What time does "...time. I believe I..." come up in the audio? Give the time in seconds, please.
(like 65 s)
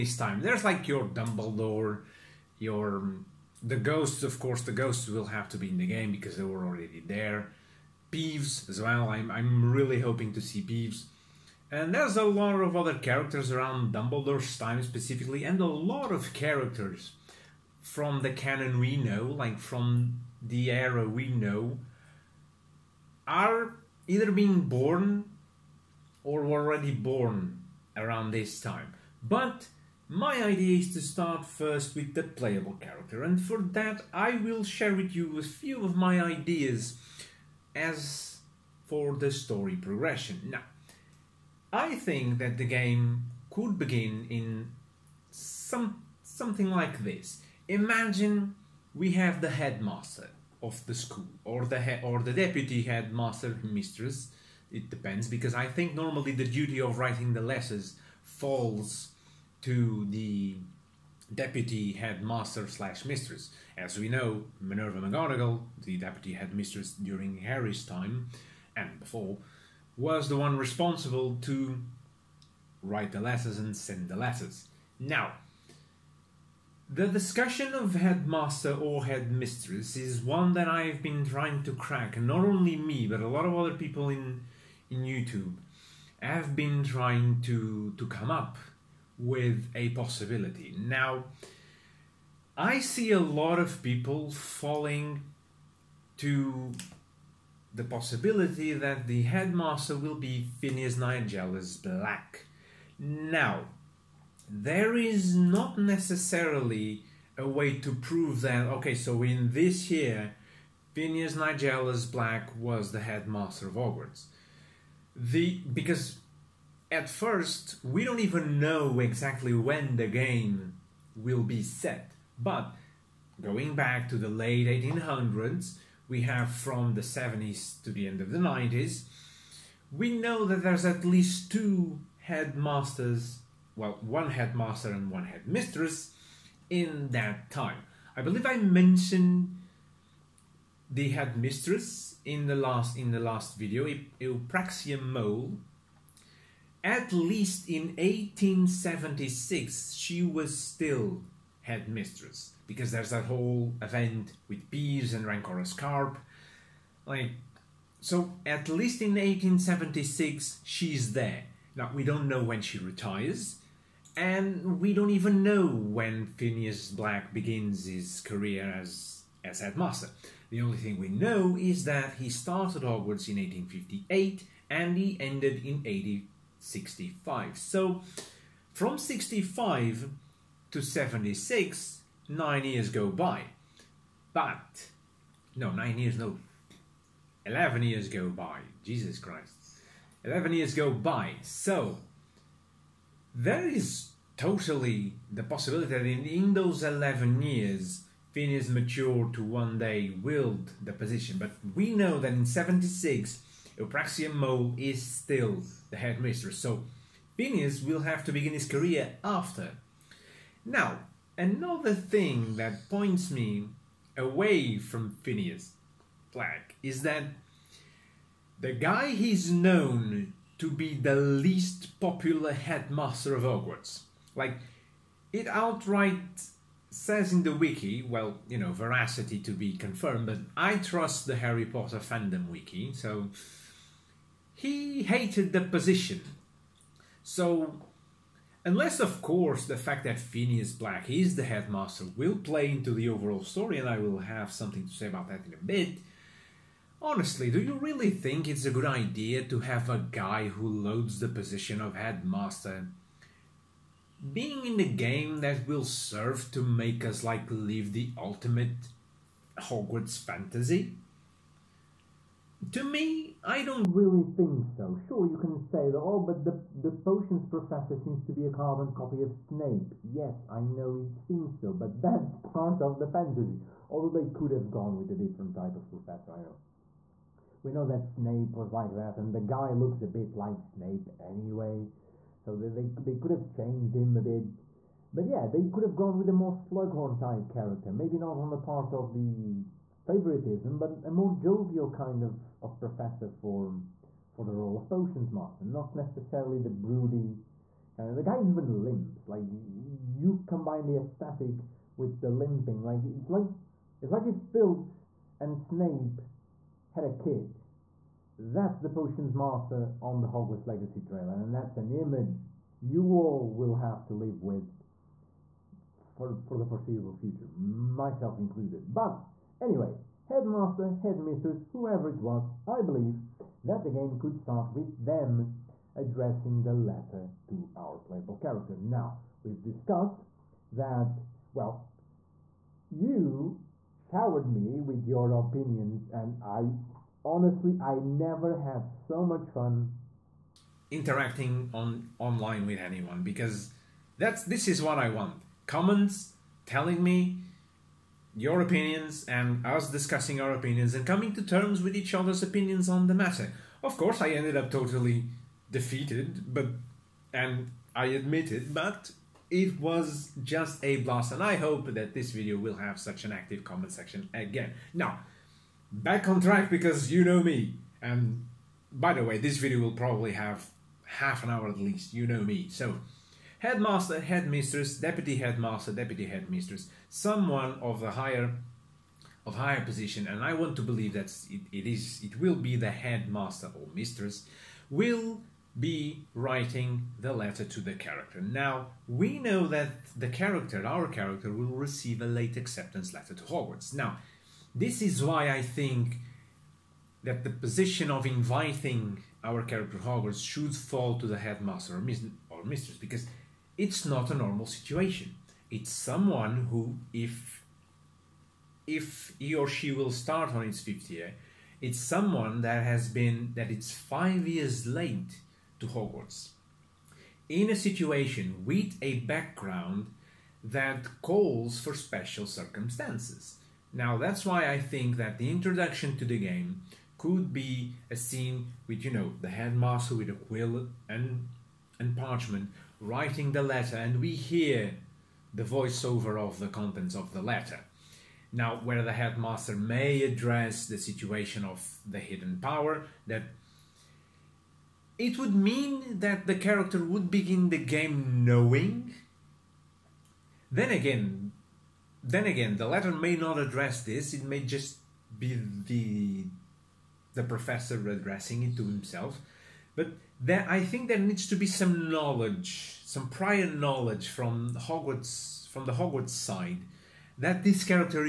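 137 s.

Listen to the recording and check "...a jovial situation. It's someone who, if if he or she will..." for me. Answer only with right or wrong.
wrong.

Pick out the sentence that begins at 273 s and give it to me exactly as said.
Although they could have gone with a different type of professor, I know.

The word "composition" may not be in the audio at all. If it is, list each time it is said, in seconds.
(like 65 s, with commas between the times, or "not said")
not said.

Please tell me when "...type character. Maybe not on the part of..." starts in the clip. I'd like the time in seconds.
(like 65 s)
287 s.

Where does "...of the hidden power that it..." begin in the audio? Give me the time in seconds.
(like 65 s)
441 s.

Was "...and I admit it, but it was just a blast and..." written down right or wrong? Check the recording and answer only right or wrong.
right.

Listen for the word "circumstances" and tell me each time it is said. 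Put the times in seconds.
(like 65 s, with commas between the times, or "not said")
422 s.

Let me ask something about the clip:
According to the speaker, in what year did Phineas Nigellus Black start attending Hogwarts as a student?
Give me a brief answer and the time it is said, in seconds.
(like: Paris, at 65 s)
1858, at 173 s.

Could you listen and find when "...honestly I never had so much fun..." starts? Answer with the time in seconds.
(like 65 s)
337 s.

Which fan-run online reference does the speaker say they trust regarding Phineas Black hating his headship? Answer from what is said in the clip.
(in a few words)
Harry Potter fandom wiki.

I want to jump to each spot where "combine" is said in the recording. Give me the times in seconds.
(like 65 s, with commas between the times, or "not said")
300 s.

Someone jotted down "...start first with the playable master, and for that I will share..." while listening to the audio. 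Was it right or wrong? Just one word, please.
wrong.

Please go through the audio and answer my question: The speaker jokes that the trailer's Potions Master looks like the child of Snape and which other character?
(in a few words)
Filch.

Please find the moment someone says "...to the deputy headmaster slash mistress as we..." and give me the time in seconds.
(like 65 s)
59 s.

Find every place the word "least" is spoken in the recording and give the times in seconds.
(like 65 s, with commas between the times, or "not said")
131 s, 147 s, 158 s, 221 s, 371 s.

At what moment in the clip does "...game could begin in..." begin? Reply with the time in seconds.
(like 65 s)
42 s.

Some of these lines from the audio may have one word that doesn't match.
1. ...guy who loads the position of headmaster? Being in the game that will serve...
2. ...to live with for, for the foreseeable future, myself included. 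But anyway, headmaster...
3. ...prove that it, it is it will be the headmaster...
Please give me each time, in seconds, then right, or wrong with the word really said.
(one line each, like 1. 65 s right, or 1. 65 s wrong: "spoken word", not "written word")
1. 250 s right
2. 314 s right
3. 380 s wrong: "believe", not "prove".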